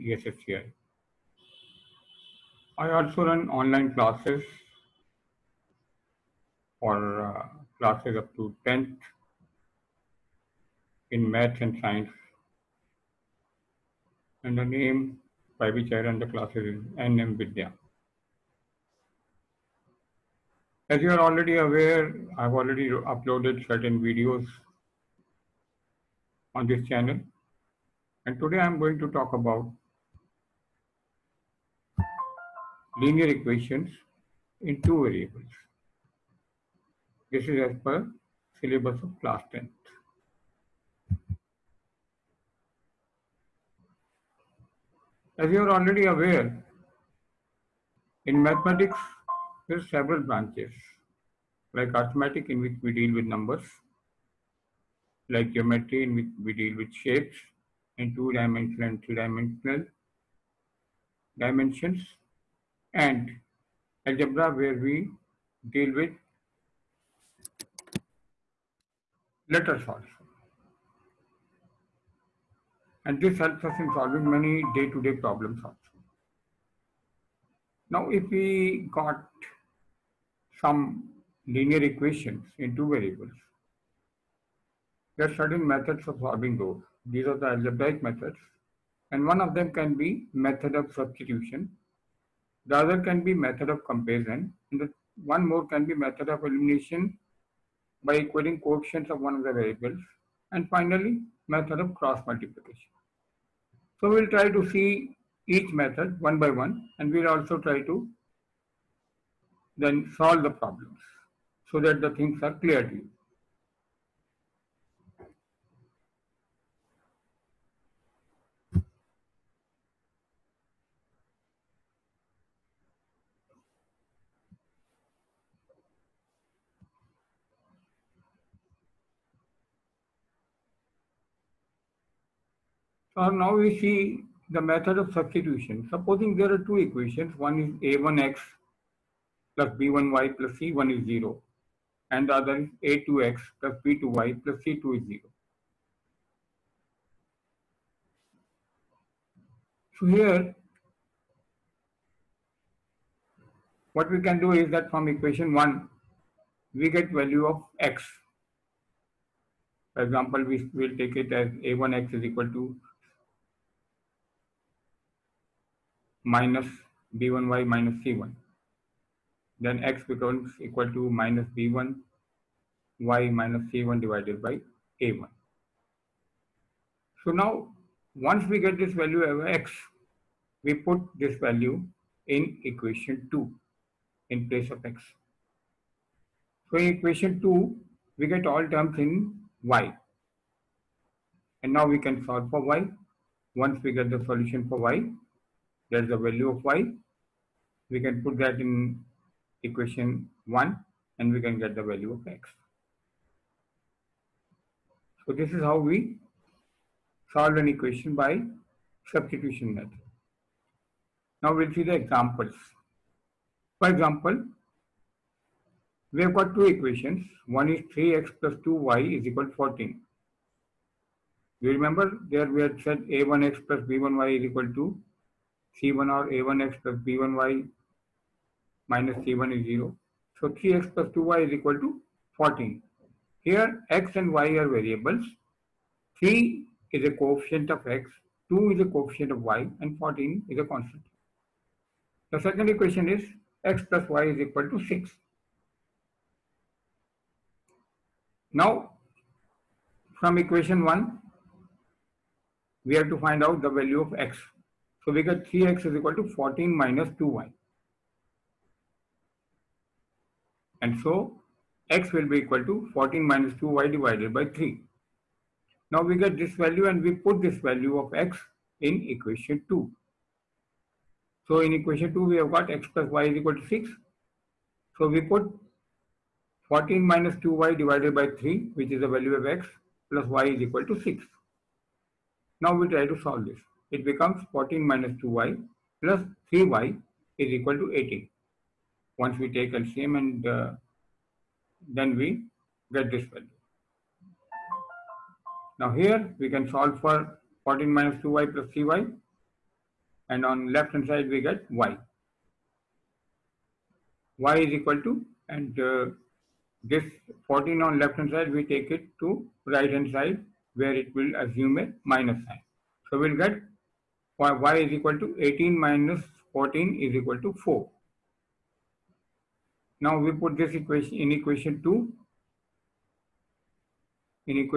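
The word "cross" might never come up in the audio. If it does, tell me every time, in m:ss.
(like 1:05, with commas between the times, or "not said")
1:41.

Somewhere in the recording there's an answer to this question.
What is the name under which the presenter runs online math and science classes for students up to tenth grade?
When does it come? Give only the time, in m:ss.
0:16.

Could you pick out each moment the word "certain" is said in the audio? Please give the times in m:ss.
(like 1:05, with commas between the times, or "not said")
0:23, 1:25.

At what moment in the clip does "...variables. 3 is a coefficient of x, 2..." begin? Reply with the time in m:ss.
3:54.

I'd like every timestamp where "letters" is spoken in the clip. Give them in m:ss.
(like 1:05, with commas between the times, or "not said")
1:09.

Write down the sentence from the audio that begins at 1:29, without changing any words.
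And one of them can be method of substitution.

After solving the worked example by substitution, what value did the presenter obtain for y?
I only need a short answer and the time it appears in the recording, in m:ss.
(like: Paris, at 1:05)
4, at 5:17.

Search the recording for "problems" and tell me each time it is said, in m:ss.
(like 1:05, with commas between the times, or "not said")
1:15, 1:50.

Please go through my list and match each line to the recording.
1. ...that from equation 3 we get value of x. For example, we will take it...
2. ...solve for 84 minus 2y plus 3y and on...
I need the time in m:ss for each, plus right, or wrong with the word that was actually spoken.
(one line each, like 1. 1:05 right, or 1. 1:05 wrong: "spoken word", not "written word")
1. 2:34 wrong: "1", not "3"
2. 4:56 wrong: "14", not "84".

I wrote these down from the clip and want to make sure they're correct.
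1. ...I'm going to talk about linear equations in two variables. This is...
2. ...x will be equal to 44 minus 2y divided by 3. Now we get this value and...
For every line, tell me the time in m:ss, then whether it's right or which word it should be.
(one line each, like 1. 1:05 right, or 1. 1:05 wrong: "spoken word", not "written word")
1. 0:28 right
2. 4:21 wrong: "14", not "44".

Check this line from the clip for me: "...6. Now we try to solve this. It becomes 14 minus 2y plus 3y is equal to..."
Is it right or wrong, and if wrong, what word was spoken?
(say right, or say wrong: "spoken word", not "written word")
right.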